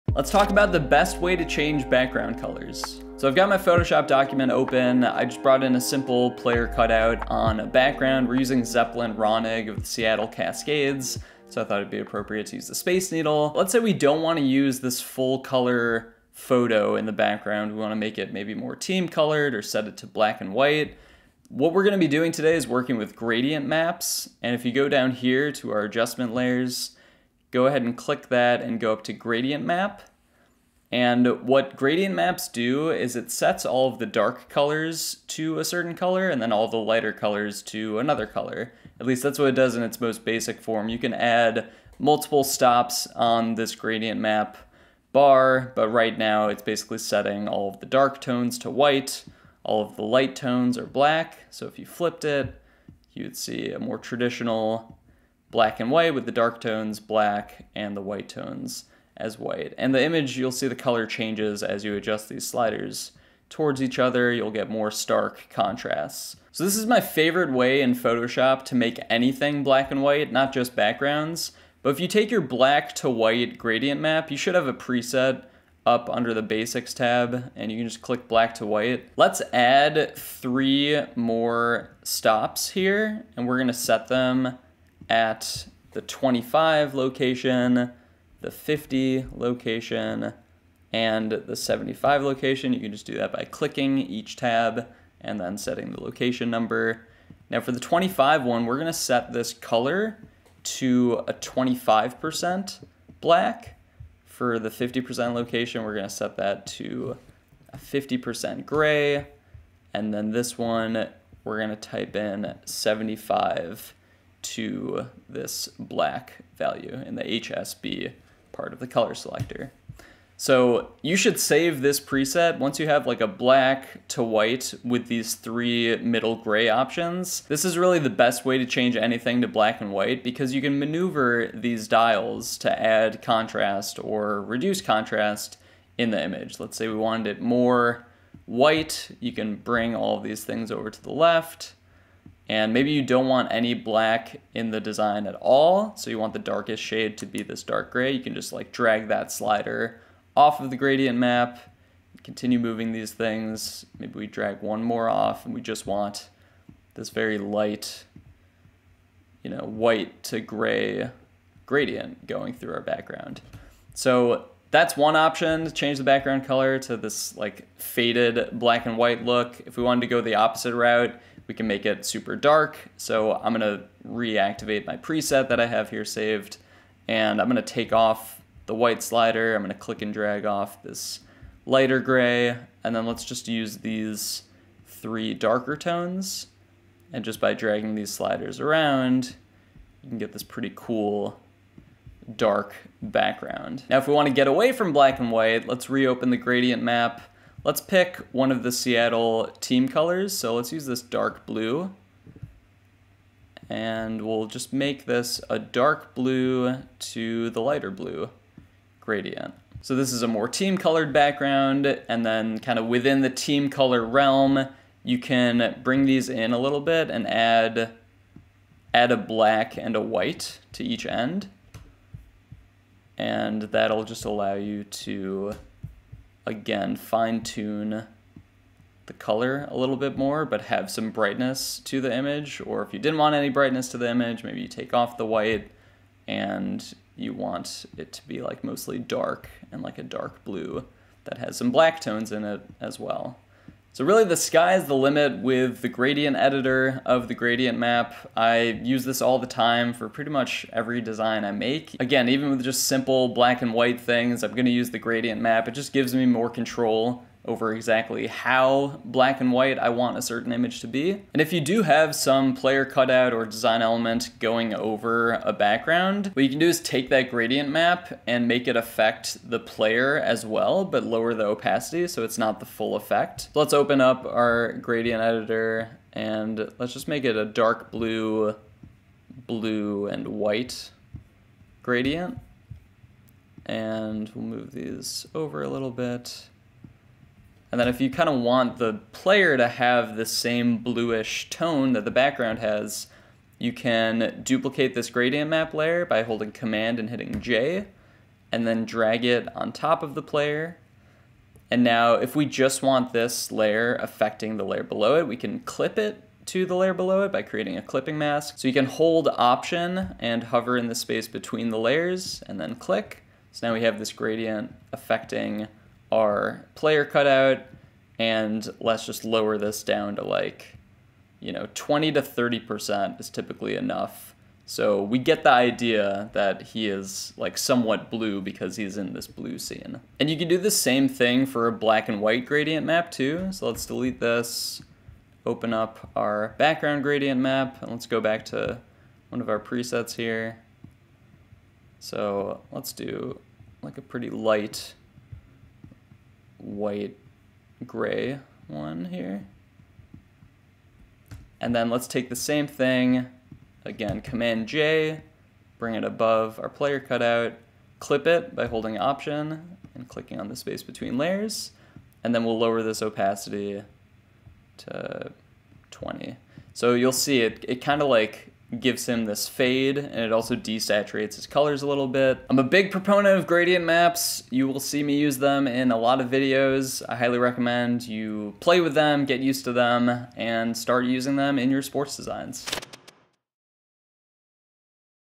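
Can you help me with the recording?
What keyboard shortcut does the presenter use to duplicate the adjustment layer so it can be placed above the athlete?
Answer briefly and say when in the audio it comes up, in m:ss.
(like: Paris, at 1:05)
Command J, at 4:56.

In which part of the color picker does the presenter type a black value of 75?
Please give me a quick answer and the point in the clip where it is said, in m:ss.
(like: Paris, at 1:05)
HSB, at 1:57.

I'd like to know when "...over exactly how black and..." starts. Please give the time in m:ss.
4:17.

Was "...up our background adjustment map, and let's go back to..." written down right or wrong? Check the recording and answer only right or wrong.
wrong.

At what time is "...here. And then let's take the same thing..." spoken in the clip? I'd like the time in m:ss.
5:49.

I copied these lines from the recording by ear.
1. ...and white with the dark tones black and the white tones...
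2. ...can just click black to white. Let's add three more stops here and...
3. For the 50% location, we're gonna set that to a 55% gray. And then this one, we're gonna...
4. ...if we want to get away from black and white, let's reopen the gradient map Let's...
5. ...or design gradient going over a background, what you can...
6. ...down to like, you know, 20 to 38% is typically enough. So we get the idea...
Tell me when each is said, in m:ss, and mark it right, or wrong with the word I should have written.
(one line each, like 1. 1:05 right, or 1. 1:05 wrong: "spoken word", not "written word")
1. 0:55 right
2. 1:17 right
3. 1:44 wrong: "50", not "55"
4. 3:13 right
5. 4:23 wrong: "element", not "gradient"
6. 5:19 wrong: "30", not "38".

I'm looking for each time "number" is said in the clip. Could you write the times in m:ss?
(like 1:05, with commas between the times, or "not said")
1:36.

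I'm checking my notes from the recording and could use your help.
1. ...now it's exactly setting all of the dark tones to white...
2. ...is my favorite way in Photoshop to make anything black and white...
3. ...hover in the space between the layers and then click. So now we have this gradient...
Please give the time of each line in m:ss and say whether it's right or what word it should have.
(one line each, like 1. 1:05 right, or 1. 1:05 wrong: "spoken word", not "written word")
1. 0:46 wrong: "basically", not "exactly"
2. 1:06 right
3. 5:10 right.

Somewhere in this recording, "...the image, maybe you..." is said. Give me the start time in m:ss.
3:53.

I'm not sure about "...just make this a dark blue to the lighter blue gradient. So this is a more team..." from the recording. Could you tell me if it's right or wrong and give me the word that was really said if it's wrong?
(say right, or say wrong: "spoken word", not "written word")
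right.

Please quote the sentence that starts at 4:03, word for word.
So really the sky is the limit with the gradient editor of the gradient map.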